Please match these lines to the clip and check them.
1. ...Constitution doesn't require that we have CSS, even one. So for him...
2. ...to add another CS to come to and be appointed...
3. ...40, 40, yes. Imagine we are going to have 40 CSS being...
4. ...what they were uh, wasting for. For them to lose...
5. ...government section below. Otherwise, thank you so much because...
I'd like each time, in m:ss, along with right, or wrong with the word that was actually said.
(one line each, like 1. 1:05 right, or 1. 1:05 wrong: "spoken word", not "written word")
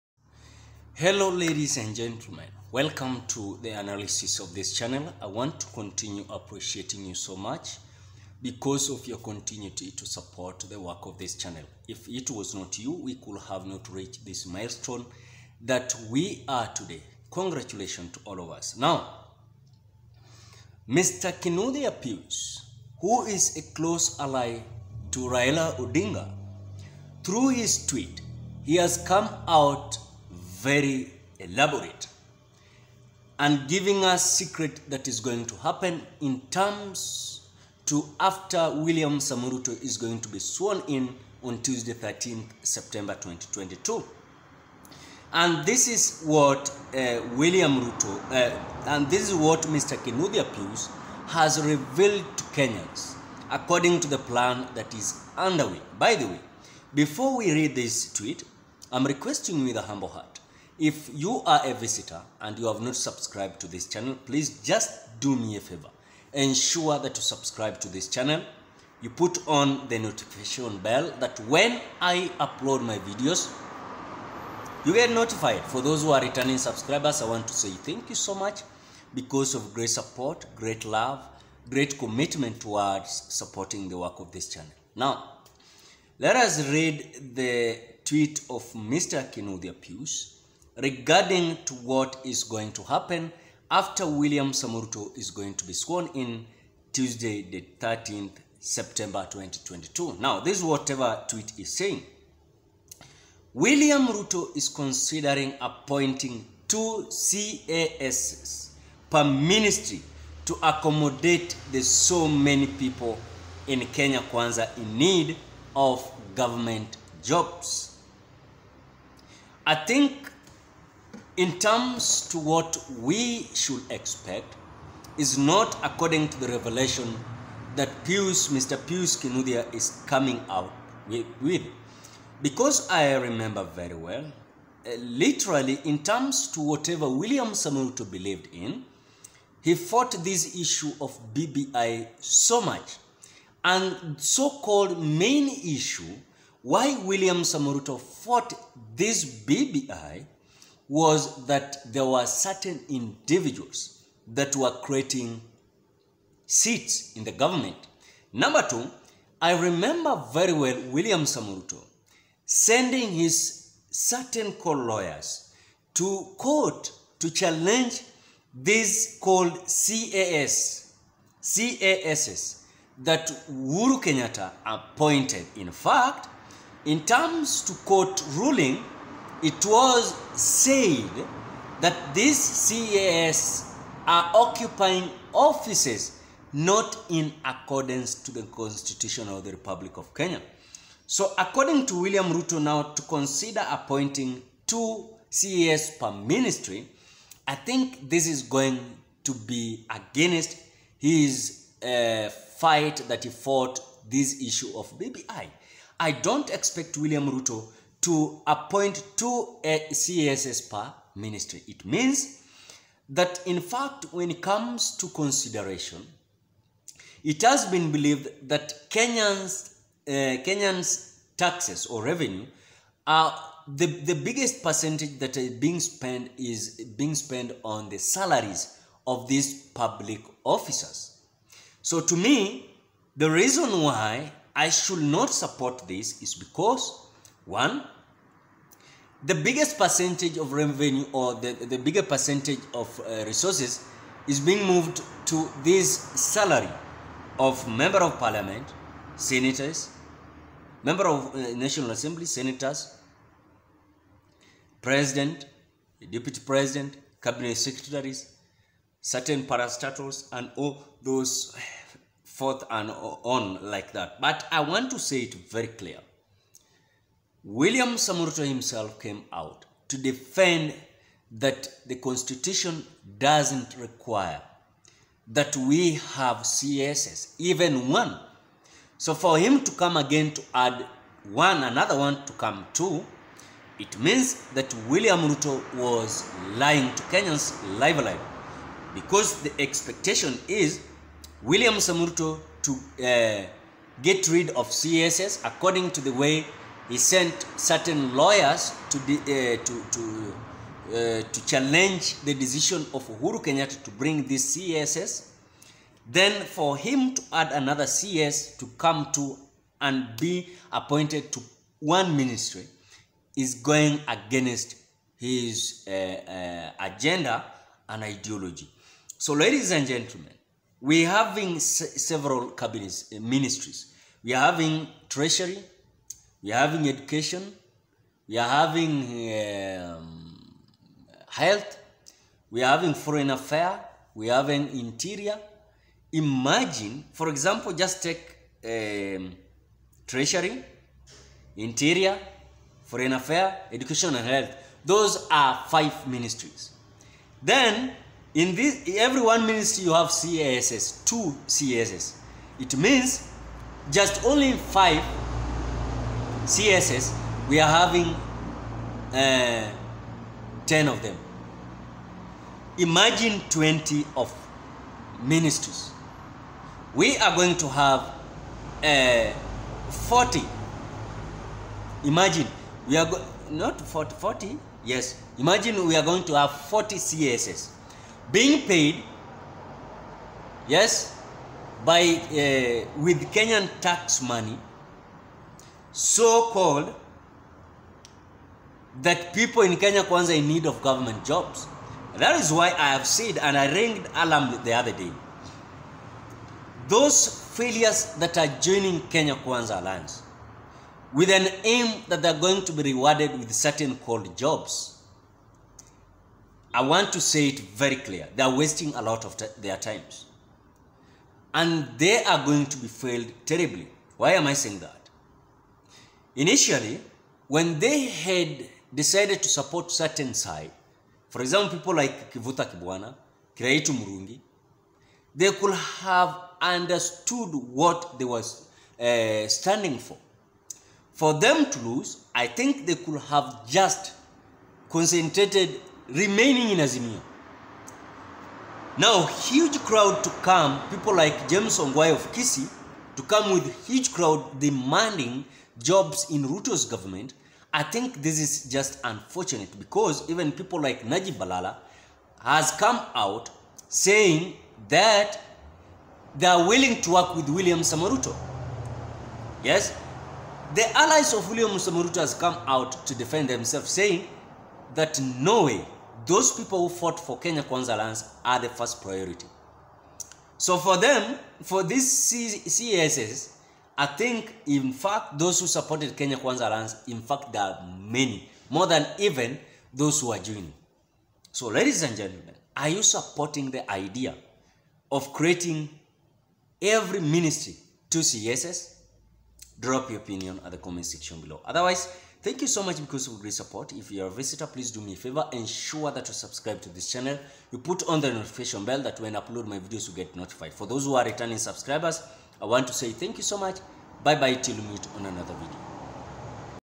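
1. 4:31 right
2. 5:07 right
3. 6:13 right
4. 7:07 wrong: "standing", not "wasting"
5. 8:10 wrong: "comment", not "government".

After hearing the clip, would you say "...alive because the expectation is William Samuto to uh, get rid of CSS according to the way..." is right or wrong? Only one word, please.
right.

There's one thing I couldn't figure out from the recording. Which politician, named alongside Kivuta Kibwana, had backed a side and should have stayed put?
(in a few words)
Kiraitu Murungi.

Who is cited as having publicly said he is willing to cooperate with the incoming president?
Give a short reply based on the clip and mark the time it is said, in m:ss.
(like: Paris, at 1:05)
Najib Balala, at 7:31.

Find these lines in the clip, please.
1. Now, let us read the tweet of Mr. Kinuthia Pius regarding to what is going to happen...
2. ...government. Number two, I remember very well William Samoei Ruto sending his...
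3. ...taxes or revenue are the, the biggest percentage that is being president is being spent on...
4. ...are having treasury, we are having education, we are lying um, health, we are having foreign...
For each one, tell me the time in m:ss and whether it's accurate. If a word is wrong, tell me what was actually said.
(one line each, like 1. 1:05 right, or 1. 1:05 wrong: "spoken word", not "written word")
1. 1:24 right
2. 2:37 right
3. 3:41 wrong: "spent", not "president"
4. 5:24 wrong: "having", not "lying".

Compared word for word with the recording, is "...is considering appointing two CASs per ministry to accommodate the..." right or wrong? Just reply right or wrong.
right.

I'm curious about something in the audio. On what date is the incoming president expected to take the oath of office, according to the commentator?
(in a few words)
Tuesday 13th September 2022.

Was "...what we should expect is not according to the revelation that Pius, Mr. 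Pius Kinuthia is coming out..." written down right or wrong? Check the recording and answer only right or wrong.
right.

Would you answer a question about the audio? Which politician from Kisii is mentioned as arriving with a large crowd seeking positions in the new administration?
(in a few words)
James Ongwae.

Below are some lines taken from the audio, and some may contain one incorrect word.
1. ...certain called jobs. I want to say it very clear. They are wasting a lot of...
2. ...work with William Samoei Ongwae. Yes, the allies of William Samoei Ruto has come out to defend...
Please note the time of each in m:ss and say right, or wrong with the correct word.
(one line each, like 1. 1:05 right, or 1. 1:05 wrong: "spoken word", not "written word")
1. 6:43 right
2. 7:37 wrong: "Ruto", not "Ongwae".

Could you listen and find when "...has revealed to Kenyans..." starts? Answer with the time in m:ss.
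0:51.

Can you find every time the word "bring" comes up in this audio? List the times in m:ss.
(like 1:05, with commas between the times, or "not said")
5:03.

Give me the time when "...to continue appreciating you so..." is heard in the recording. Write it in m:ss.
0:05.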